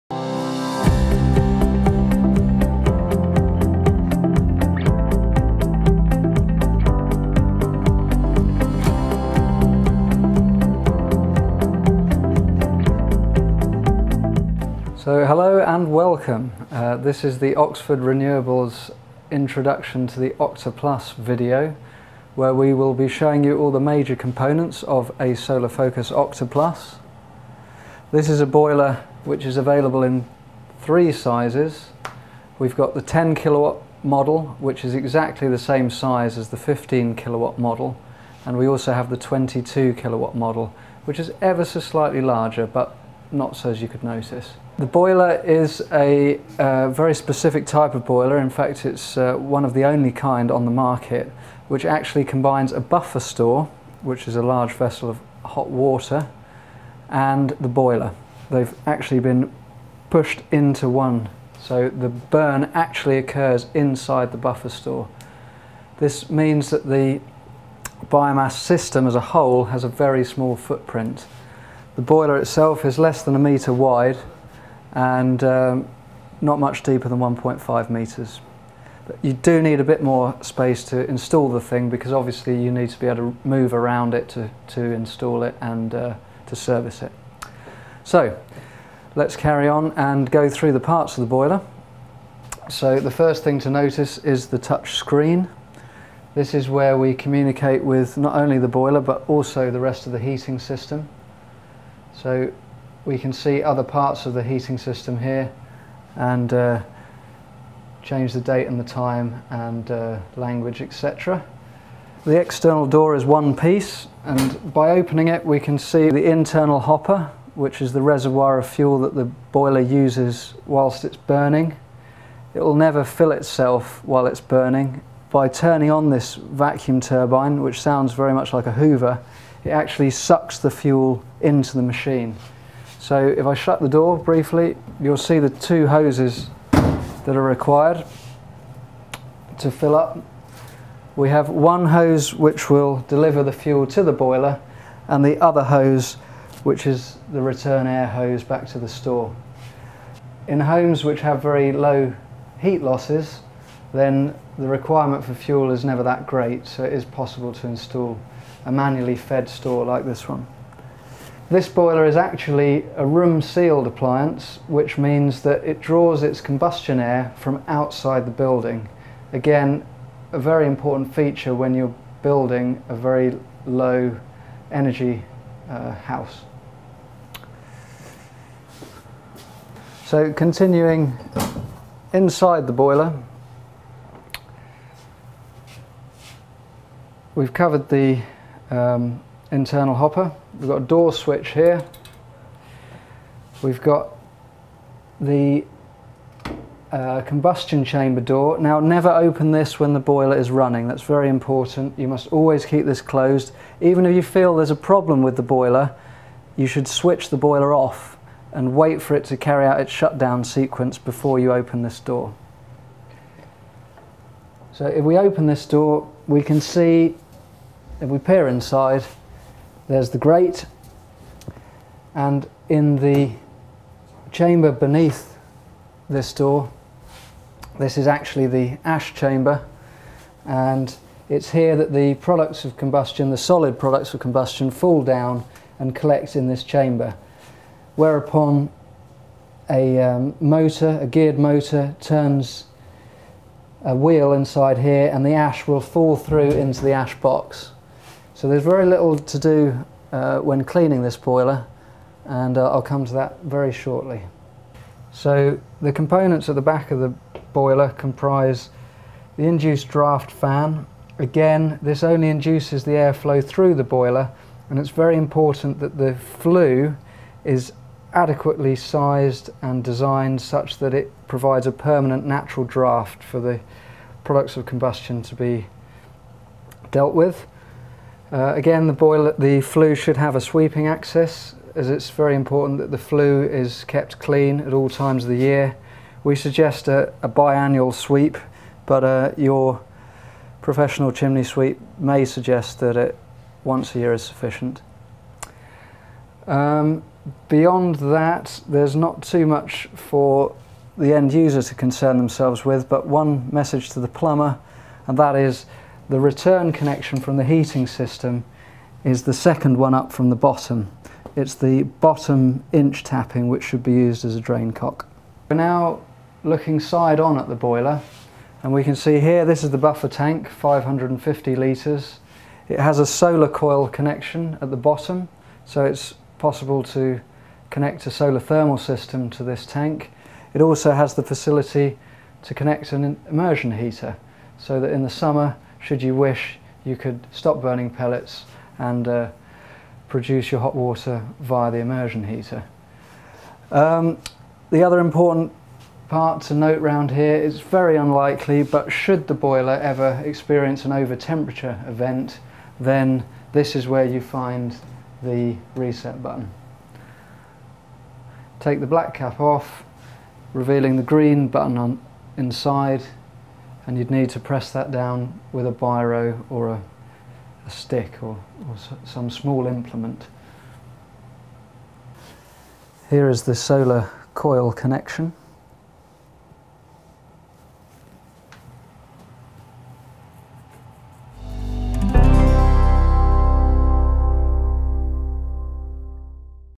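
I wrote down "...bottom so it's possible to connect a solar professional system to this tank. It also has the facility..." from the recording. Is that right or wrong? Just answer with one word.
wrong.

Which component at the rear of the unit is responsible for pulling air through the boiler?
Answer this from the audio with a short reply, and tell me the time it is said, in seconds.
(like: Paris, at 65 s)
Induced draft fan, at 259 s.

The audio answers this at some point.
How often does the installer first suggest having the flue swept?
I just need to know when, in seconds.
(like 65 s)
287 s.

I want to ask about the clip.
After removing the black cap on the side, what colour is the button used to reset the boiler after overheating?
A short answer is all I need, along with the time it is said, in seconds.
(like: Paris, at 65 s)
Green, at 361 s.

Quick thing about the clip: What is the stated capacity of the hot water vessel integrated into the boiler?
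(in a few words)
550 litres.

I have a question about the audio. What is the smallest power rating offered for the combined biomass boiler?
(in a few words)
10 kilowatt.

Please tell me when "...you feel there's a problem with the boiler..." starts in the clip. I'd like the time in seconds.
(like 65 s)
204 s.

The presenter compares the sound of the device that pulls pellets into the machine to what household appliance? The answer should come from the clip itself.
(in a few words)
Hoover.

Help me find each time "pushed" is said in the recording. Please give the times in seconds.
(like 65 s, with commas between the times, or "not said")
60 s.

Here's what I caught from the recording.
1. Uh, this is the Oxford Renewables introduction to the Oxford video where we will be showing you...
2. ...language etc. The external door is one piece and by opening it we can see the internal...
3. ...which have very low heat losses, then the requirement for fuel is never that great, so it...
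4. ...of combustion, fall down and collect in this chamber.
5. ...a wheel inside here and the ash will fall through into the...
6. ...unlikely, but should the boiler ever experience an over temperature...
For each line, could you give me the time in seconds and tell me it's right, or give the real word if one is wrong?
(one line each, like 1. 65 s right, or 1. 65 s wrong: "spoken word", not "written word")
1. 16 s wrong: "OctoPlus", not "Oxford"
2. 110 s right
3. 151 s right
4. 234 s right
5. 243 s right
6. 347 s right.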